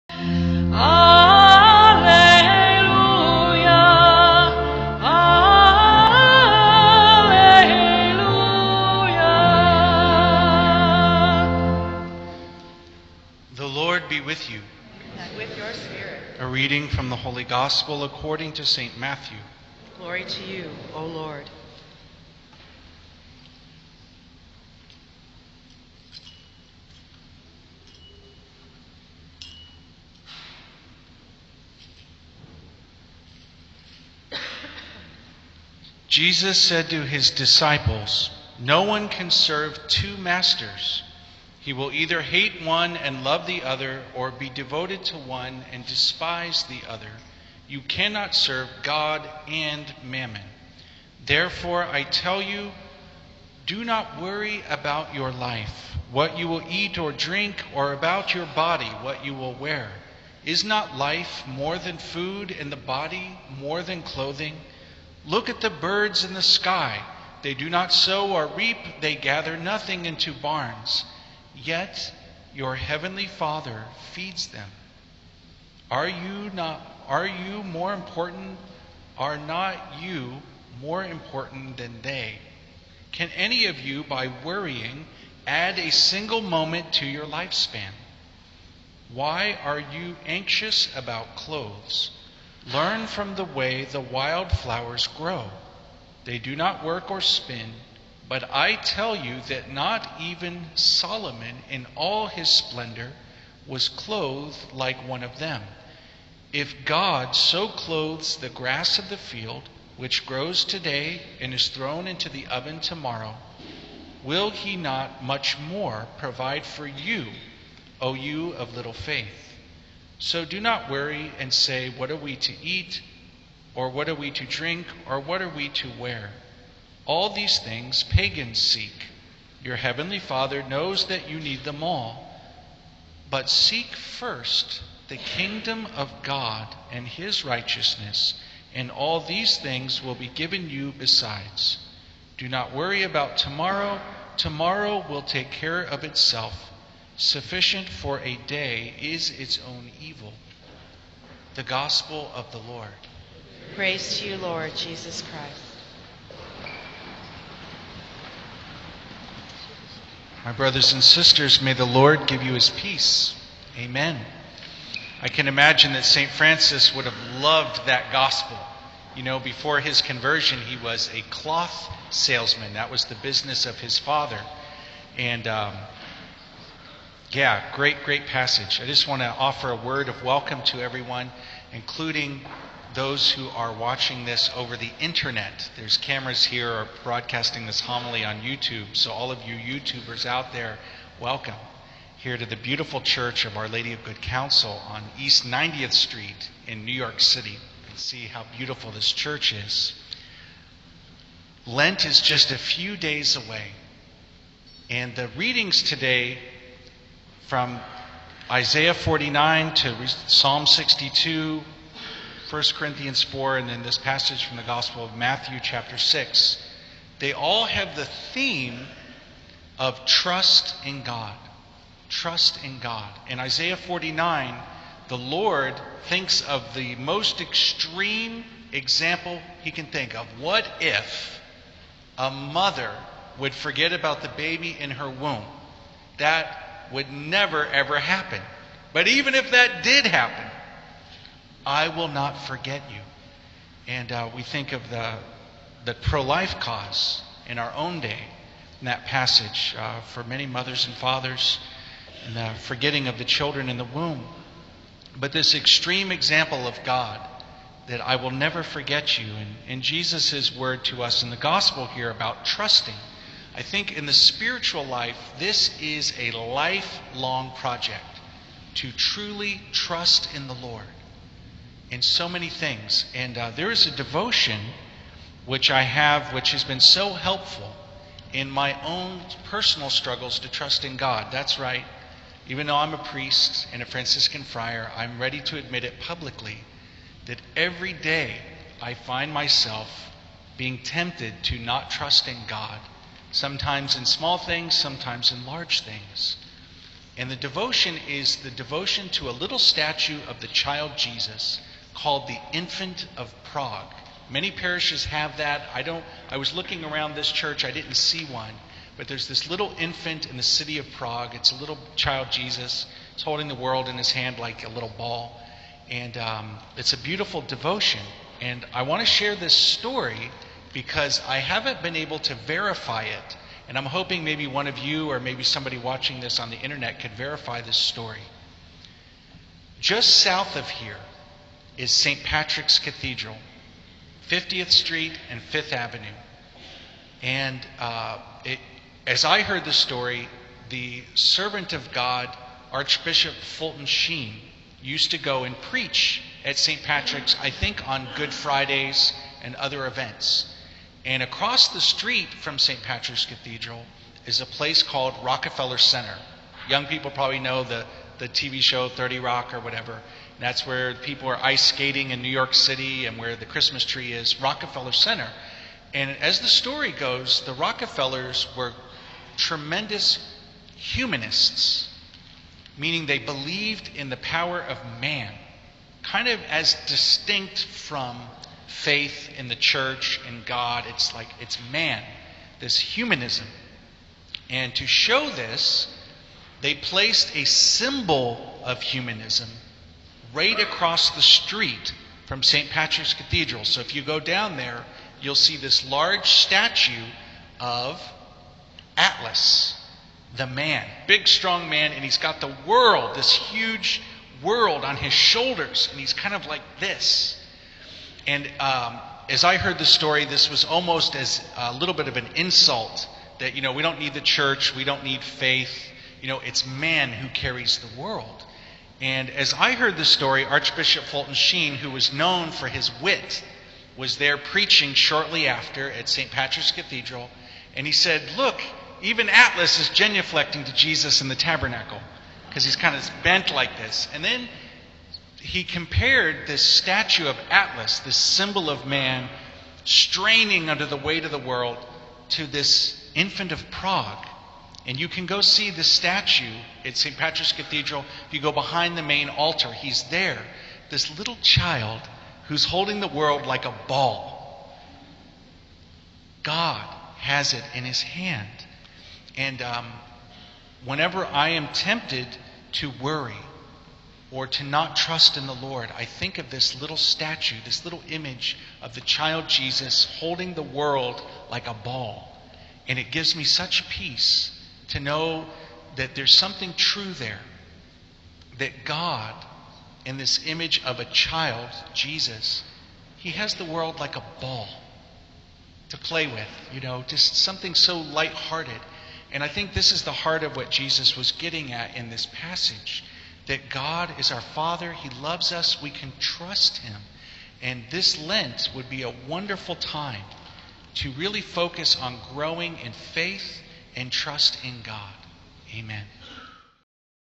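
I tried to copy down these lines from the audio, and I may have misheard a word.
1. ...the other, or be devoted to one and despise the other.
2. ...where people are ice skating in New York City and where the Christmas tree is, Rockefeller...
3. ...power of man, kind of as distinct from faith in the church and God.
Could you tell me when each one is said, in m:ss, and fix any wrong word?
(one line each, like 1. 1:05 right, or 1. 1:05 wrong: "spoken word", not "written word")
1. 0:43 right
2. 6:00 right
3. 6:14 right.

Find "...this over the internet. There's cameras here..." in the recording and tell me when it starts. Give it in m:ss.
3:04.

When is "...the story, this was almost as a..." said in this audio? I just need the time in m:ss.
6:49.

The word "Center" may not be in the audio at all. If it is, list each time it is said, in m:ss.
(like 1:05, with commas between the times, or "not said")
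5:55, 6:04.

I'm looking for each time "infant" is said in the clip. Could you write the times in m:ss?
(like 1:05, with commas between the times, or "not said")
5:02, 5:09, 7:23.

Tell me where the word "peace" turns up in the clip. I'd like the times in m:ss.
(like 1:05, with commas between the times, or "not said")
2:42, 7:53.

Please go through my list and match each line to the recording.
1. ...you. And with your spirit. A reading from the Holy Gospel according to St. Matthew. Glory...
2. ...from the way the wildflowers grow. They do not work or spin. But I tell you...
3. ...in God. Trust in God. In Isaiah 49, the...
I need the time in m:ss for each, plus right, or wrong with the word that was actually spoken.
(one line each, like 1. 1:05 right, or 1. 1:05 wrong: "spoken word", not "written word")
1. 0:14 right
2. 1:33 right
3. 3:40 right.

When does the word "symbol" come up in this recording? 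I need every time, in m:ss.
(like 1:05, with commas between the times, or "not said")
6:27, 7:18.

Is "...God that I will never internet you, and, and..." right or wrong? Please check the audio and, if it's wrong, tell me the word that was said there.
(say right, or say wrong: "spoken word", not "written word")
wrong: "forget", not "internet".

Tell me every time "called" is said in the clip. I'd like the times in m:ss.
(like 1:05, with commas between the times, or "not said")
5:02, 5:54.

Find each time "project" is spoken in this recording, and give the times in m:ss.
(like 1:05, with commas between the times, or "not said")
4:27.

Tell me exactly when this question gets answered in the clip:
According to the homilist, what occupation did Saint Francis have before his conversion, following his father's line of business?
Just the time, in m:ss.
2:51.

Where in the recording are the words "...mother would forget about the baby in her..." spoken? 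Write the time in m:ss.
3:52.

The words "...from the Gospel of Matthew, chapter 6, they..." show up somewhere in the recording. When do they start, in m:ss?
3:34.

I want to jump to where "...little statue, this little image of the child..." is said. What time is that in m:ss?
7:46.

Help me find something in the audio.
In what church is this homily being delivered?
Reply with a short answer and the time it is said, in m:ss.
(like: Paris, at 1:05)
Our Lady of Good Counsel, at 3:13.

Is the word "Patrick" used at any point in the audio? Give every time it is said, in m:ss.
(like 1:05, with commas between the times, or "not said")
5:32, 5:46, 5:52, 6:32, 7:06, 7:27.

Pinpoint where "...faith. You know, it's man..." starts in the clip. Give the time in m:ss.
6:55.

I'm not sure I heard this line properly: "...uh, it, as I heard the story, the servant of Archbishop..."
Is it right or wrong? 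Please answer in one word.
wrong.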